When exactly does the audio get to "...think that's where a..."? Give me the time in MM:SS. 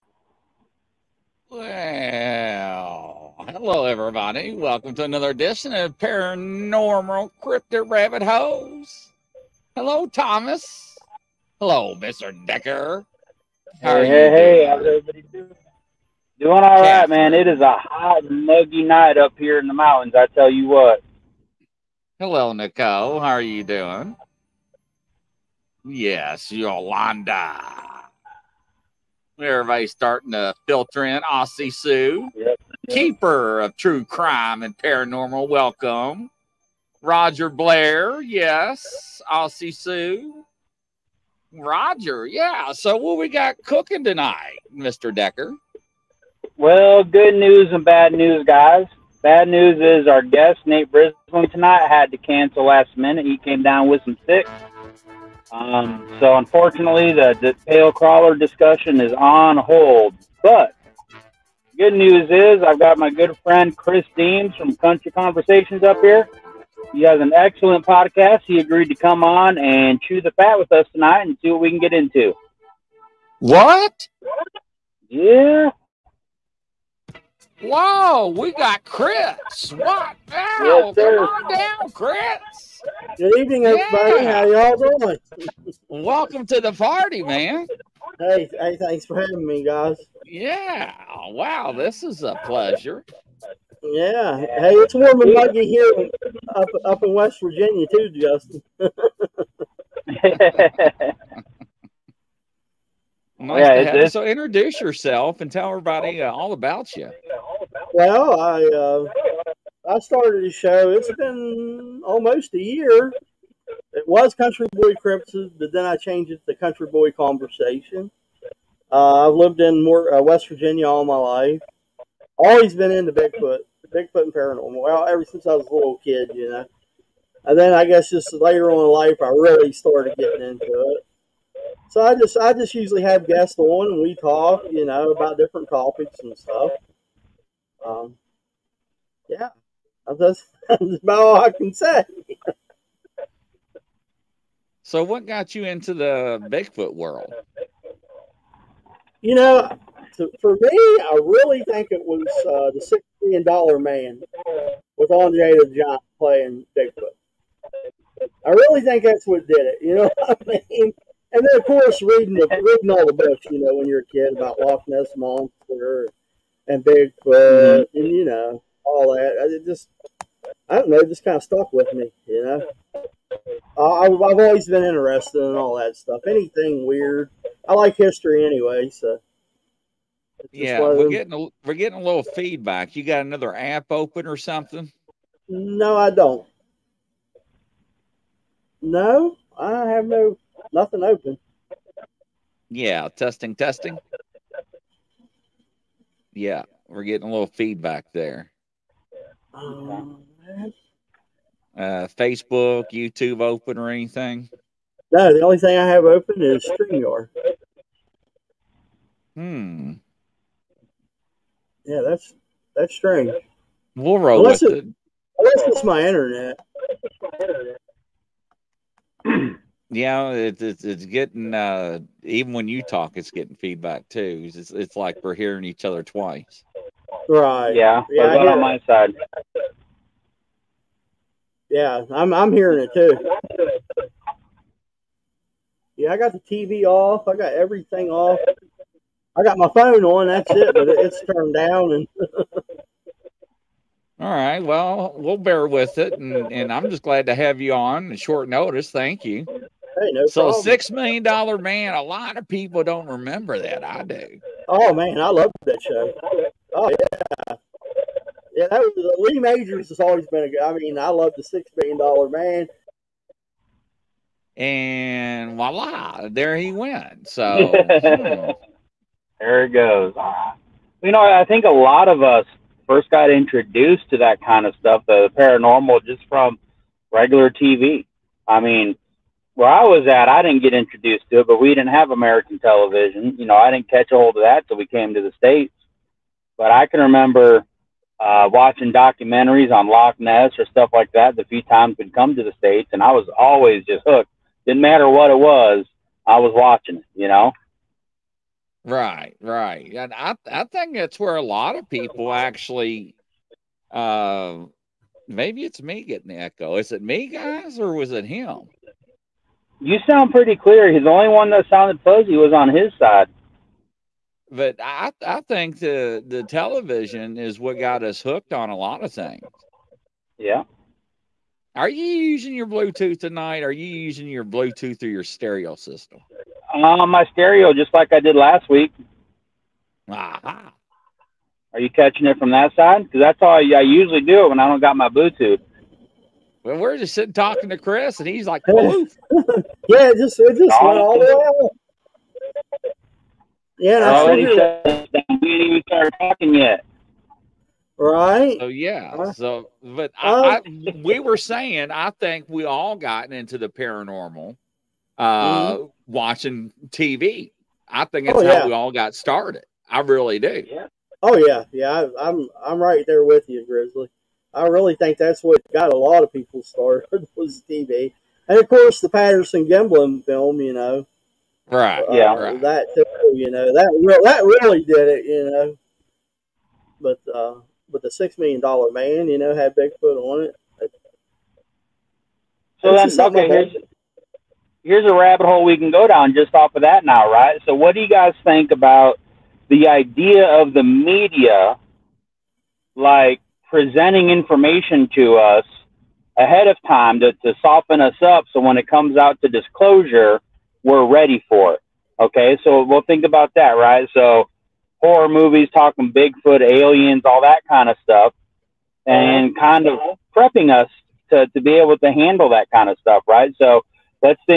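05:00.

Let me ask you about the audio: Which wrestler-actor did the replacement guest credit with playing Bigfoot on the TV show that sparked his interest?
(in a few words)
Andre the Giant.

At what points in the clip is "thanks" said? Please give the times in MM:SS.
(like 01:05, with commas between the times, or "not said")
01:28, 04:08.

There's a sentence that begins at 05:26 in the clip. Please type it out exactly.
Uh, my stereo, just like I did last week.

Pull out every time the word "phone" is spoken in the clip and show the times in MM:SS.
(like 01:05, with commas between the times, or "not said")
03:59.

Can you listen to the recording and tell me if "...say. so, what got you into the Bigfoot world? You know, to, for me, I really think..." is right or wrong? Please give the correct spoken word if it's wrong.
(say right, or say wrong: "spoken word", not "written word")
right.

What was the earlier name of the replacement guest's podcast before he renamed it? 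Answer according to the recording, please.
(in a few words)
Country Boy Crimson.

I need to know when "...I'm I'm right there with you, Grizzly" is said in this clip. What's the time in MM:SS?
06:02.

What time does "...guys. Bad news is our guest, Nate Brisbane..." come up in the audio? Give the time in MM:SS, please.
00:48.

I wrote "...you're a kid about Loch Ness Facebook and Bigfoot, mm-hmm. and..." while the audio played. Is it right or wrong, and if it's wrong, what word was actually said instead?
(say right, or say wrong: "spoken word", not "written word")
wrong: "Monster", not "Facebook".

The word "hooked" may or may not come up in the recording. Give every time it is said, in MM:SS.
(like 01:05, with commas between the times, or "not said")
04:54, 05:18.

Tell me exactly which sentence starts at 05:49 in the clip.
So, but uh, I, we were saying, I think we all gotten into the paranormal uh, mm-hmm.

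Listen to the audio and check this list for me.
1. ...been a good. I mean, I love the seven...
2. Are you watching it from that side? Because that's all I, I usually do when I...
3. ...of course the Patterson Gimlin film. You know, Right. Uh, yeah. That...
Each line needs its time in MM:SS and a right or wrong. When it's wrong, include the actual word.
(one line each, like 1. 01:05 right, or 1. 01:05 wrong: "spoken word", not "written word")
1. 04:20 wrong: "six", not "seven"
2. 05:31 wrong: "catching", not "watching"
3. 06:08 right.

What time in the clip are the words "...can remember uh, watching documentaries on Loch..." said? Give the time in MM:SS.
04:46.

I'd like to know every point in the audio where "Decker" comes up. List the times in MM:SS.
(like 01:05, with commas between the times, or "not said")
00:12, 00:45.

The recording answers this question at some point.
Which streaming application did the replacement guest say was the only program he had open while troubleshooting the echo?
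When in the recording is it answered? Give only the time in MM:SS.
03:26.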